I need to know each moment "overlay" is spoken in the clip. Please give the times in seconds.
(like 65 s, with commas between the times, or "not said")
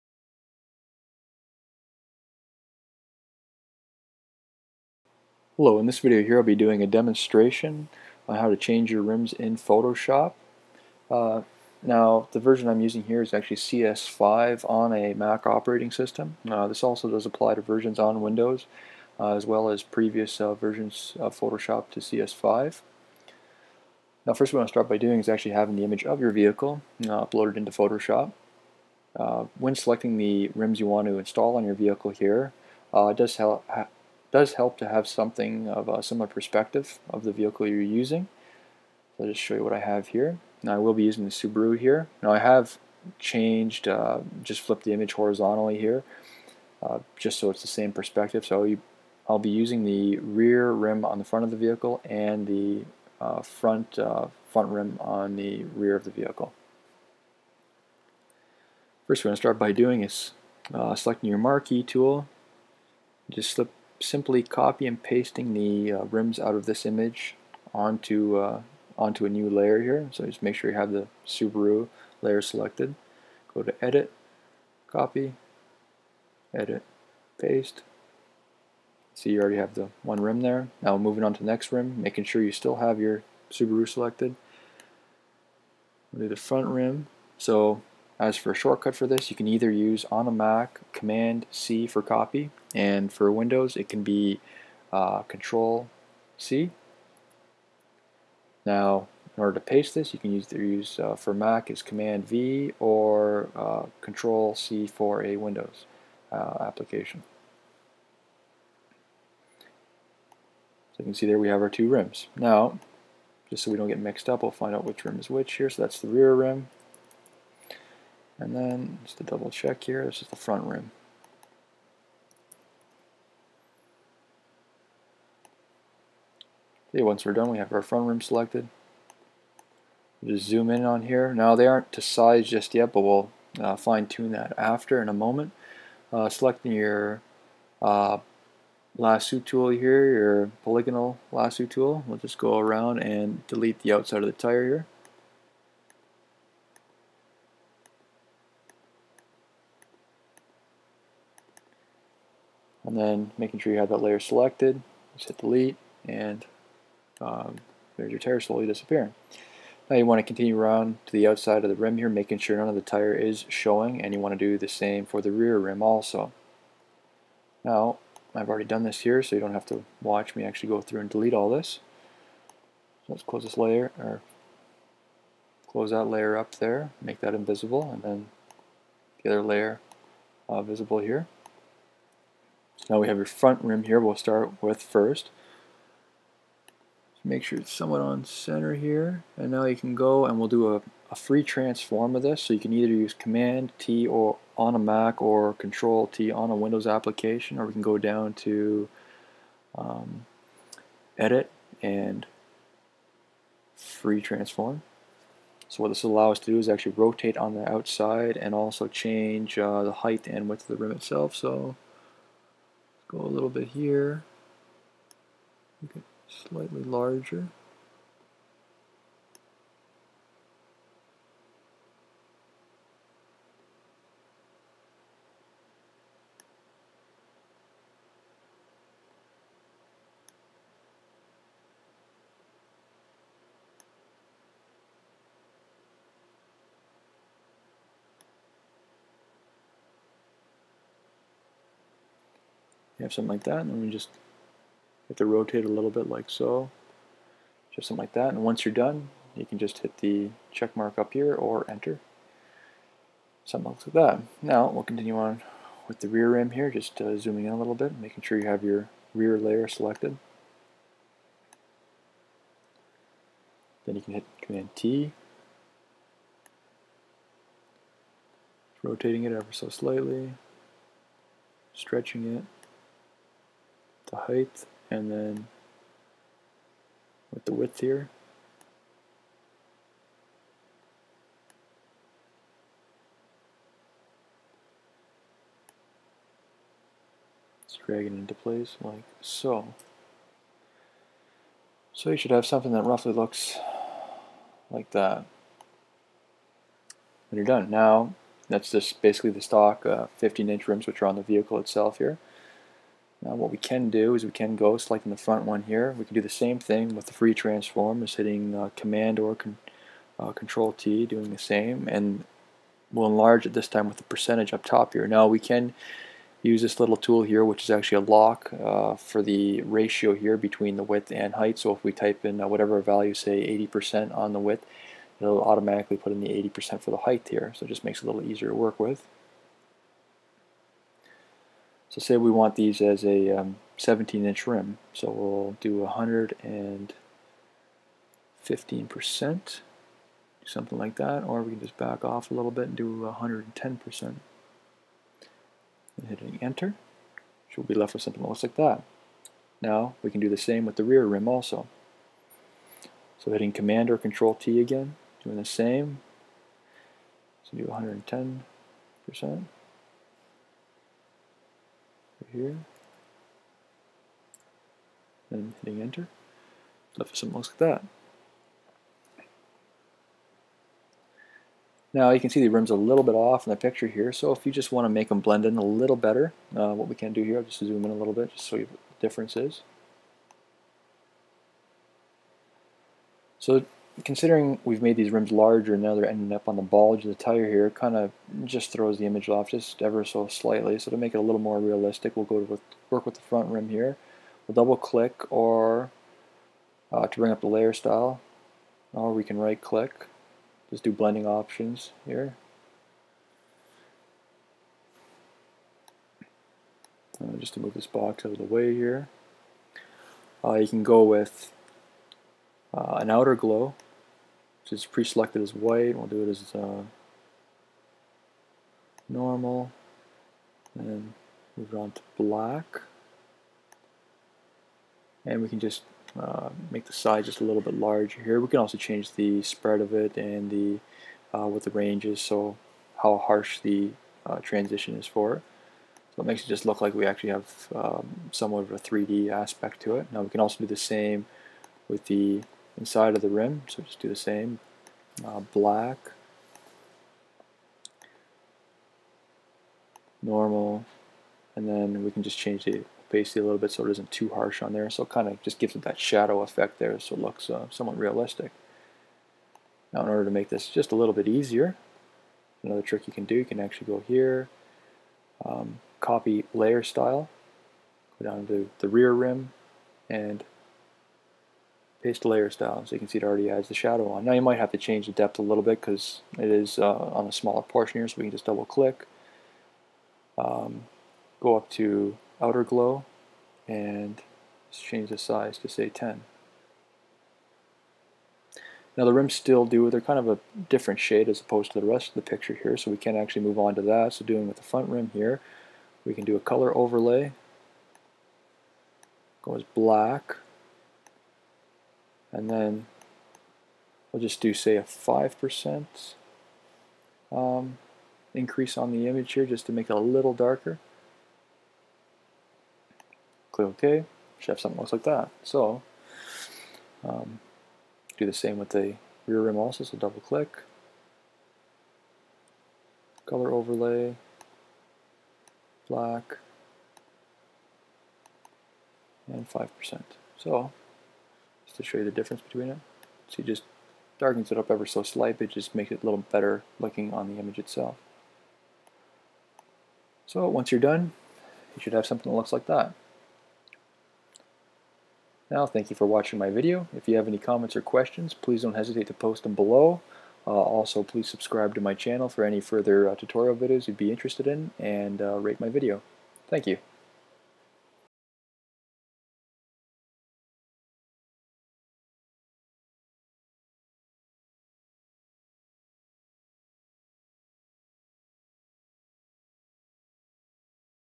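496 s, 523 s.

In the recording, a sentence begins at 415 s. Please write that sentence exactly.
We'll do it as uh, normal, and move it on to black.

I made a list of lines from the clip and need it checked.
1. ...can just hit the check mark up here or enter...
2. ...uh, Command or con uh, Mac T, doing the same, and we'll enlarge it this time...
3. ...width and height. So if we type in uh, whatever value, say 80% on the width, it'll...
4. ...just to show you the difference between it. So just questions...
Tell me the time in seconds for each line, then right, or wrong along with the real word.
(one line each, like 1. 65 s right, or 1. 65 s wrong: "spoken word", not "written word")
1. 249 s right
2. 308 s wrong: "Control", not "Mac"
3. 320 s right
4. 531 s wrong: "darkens", not "questions".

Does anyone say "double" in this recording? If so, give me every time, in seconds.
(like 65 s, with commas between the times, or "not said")
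119 s, 394 s, 478 s, 519 s.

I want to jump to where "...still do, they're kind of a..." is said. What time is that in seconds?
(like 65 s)
489 s.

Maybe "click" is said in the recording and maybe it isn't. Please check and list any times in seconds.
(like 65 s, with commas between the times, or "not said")
394 s, 399 s, 478 s, 513 s, 520 s.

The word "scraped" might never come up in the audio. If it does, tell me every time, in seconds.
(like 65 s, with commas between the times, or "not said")
not said.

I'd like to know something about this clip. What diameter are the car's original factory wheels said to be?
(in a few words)
15-inch.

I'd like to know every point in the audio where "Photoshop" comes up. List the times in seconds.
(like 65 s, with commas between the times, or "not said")
9 s, 21 s, 27 s.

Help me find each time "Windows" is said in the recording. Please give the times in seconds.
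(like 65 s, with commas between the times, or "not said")
18 s, 93 s, 105 s, 196 s.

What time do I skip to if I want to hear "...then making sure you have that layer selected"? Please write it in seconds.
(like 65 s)
152 s.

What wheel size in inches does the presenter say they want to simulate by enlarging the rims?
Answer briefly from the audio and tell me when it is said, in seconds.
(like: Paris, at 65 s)
17 inch, at 333 s.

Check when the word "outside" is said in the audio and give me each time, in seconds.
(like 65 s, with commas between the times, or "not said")
143 s, 161 s, 207 s.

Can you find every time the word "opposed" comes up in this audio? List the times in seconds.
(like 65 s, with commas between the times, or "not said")
491 s.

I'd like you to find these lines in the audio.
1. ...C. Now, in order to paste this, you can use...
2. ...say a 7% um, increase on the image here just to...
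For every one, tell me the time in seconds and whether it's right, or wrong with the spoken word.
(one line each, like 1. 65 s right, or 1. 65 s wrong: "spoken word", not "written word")
1. 96 s right
2. 504 s wrong: "5", not "7".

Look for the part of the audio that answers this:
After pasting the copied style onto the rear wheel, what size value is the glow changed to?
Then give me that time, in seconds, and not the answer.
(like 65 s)
485 s.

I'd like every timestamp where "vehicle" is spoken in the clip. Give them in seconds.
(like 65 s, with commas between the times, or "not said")
26 s, 31 s, 37 s, 51 s, 56 s, 301 s.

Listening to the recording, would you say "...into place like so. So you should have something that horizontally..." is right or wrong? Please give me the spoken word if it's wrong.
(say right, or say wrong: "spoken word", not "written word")
wrong: "roughly", not "horizontally".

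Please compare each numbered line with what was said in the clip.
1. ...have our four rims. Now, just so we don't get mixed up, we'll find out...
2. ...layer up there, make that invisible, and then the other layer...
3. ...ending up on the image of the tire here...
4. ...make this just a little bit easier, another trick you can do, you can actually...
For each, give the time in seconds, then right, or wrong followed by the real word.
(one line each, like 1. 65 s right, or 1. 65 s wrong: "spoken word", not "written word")
1. 111 s wrong: "two", not "four"
2. 176 s right
3. 386 s wrong: "bulge", not "image"
4. 460 s right.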